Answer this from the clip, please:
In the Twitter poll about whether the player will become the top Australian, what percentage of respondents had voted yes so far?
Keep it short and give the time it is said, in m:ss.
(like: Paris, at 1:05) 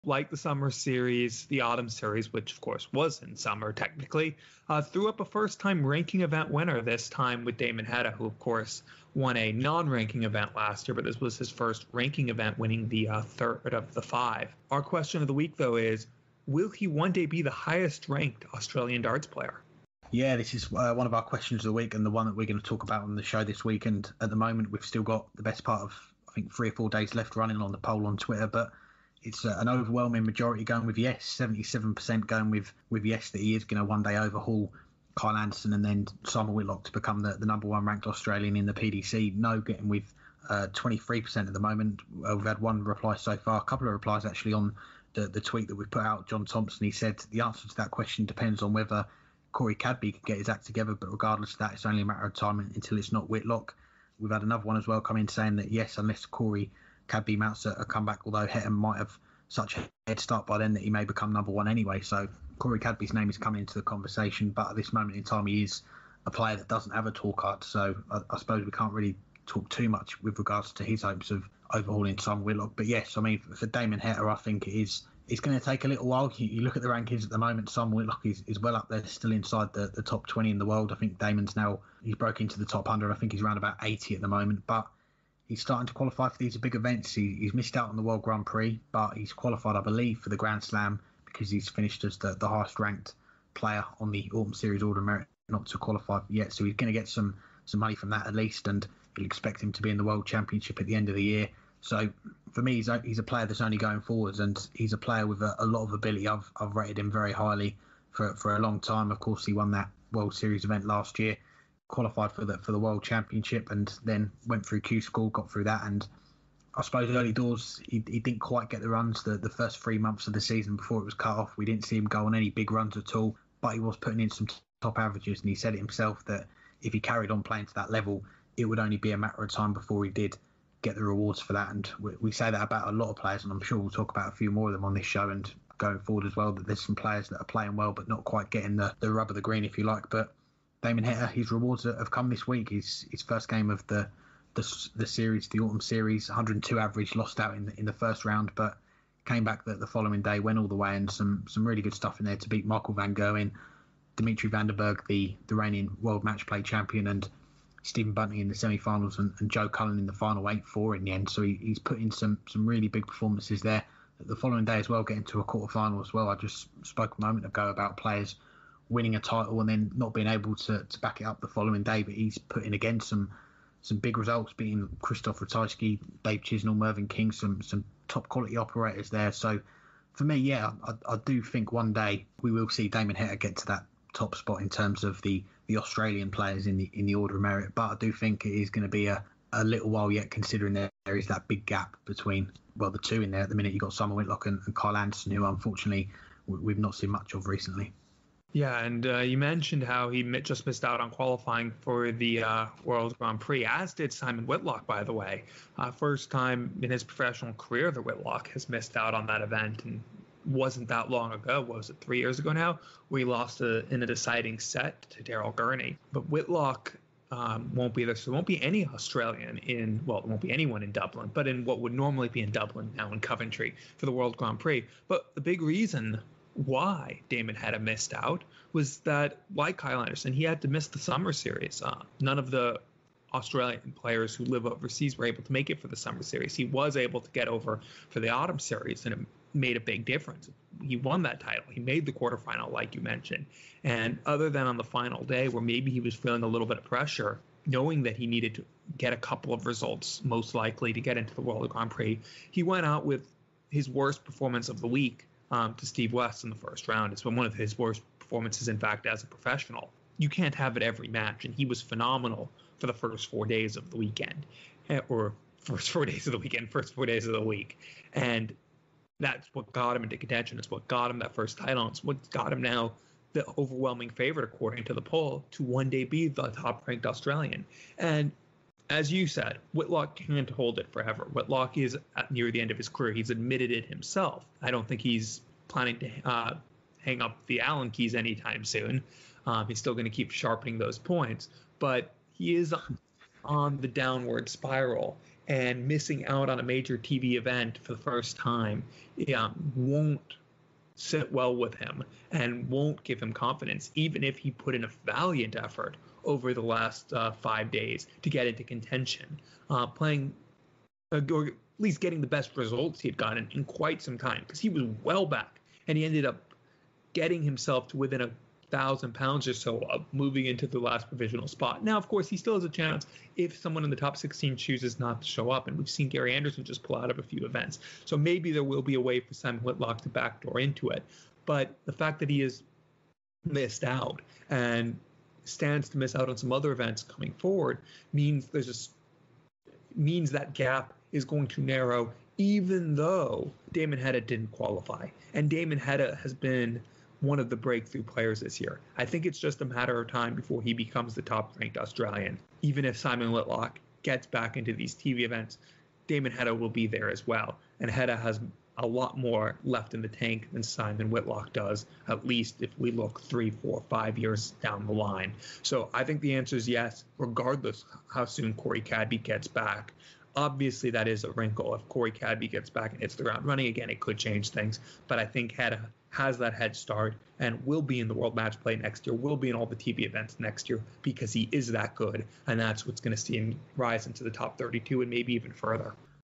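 77%, at 0:31.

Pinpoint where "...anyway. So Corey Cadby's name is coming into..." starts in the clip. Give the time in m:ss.
1:01.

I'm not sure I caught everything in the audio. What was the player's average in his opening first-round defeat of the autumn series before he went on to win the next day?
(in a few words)
102.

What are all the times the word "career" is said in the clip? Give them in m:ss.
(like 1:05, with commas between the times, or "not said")
3:27, 4:42.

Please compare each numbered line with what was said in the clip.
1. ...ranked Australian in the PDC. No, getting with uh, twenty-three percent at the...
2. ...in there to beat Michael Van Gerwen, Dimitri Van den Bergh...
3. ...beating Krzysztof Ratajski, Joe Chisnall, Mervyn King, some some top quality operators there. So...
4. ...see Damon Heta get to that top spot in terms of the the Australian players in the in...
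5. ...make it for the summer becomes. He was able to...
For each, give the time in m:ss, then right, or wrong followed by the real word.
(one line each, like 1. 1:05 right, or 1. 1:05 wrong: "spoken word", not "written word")
1. 0:37 right
2. 2:32 right
3. 2:54 wrong: "Dave", not "Joe"
4. 3:02 right
5. 3:55 wrong: "series", not "becomes".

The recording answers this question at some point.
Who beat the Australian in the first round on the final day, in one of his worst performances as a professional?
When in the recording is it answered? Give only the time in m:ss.
4:15.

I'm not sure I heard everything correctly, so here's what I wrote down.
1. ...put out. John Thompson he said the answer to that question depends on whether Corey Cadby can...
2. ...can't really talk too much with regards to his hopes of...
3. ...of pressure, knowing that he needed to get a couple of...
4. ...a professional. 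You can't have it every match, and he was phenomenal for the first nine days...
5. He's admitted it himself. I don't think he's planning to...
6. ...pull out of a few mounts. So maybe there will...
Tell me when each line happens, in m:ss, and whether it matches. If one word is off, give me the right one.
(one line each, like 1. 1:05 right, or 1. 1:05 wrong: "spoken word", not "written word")
1. 0:45 right
2. 1:08 right
3. 4:06 right
4. 4:19 wrong: "four", not "nine"
5. 4:43 right
6. 5:26 wrong: "events", not "mounts".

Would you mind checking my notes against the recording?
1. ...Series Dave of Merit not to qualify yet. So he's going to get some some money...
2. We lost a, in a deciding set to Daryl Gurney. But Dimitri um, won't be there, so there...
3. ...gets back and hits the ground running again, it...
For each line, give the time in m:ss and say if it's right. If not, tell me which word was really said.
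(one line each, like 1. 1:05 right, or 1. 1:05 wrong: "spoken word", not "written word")
1. 1:34 wrong: "Order", not "Dave"
2. 3:33 wrong: "Whitlock", not "Dimitri"
3. 6:12 right.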